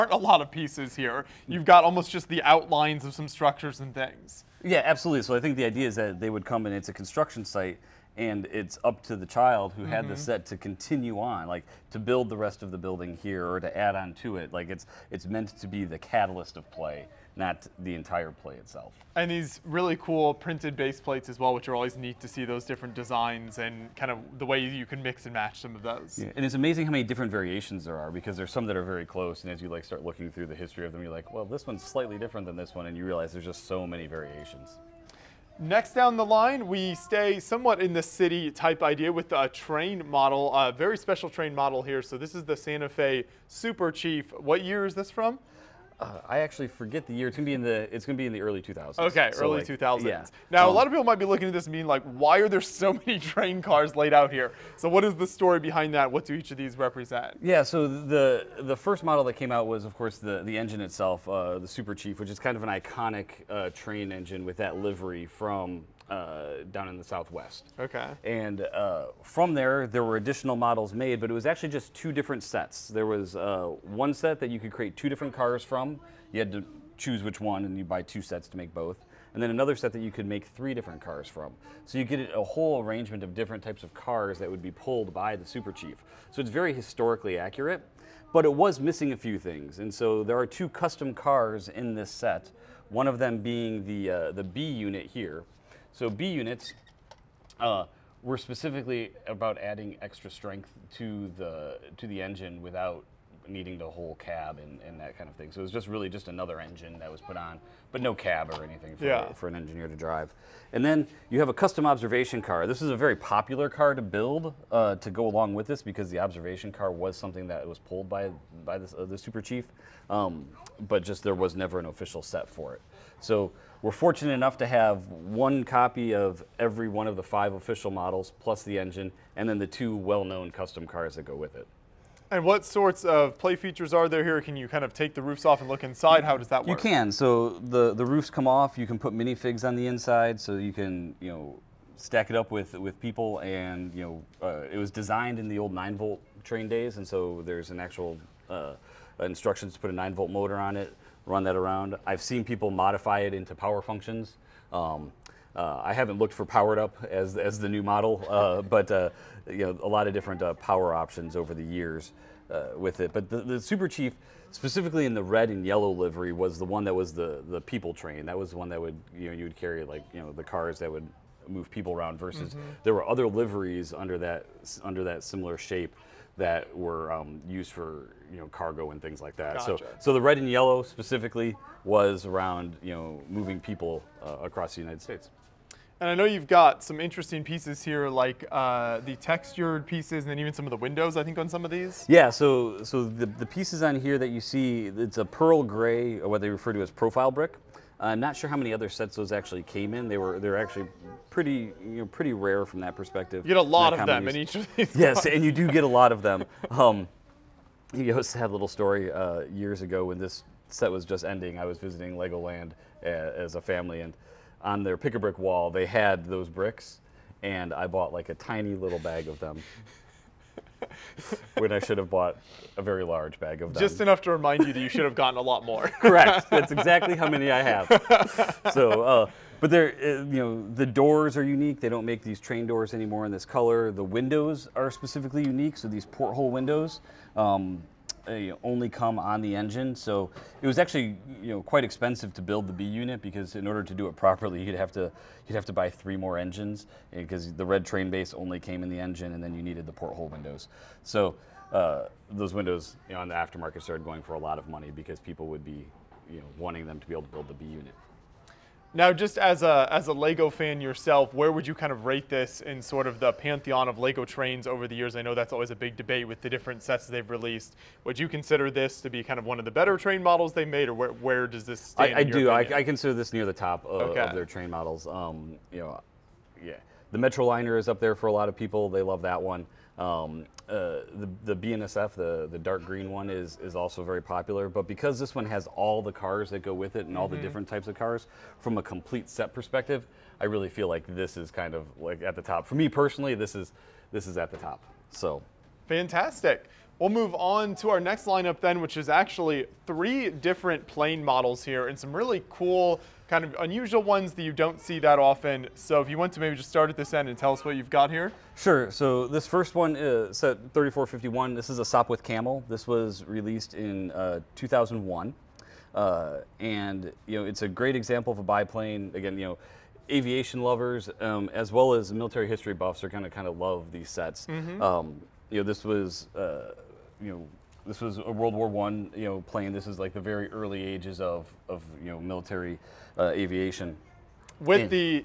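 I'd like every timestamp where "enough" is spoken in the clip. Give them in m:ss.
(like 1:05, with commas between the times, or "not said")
2:04, 3:43.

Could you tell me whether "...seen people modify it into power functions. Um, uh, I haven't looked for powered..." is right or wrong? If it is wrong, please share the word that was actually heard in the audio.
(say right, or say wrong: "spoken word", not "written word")
right.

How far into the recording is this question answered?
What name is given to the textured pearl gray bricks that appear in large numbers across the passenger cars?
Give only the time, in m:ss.
3:16.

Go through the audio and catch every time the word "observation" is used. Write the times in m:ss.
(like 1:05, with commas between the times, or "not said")
1:51, 1:56.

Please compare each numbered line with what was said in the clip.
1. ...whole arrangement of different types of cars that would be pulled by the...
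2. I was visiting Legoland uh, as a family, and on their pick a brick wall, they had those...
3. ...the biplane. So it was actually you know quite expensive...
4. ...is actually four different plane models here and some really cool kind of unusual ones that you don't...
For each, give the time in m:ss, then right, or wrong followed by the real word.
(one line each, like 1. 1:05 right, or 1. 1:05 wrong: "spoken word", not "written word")
1. 1:22 right
2. 3:31 right
3. 3:59 wrong: "engine", not "biplane"
4. 4:58 wrong: "three", not "four".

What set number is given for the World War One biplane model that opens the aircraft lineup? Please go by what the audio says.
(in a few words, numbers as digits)
3451.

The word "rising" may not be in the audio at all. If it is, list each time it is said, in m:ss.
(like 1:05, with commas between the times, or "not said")
not said.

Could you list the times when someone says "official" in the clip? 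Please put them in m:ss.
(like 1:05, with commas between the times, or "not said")
2:01, 2:07.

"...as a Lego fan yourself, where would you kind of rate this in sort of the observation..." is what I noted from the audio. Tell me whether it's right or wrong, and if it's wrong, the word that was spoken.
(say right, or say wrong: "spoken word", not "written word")
wrong: "pantheon", not "observation".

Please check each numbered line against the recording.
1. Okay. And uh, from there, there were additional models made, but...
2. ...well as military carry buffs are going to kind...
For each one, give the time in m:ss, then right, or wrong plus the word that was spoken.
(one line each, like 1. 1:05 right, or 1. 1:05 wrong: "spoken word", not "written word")
1. 1:07 right
2. 5:21 wrong: "history", not "carry".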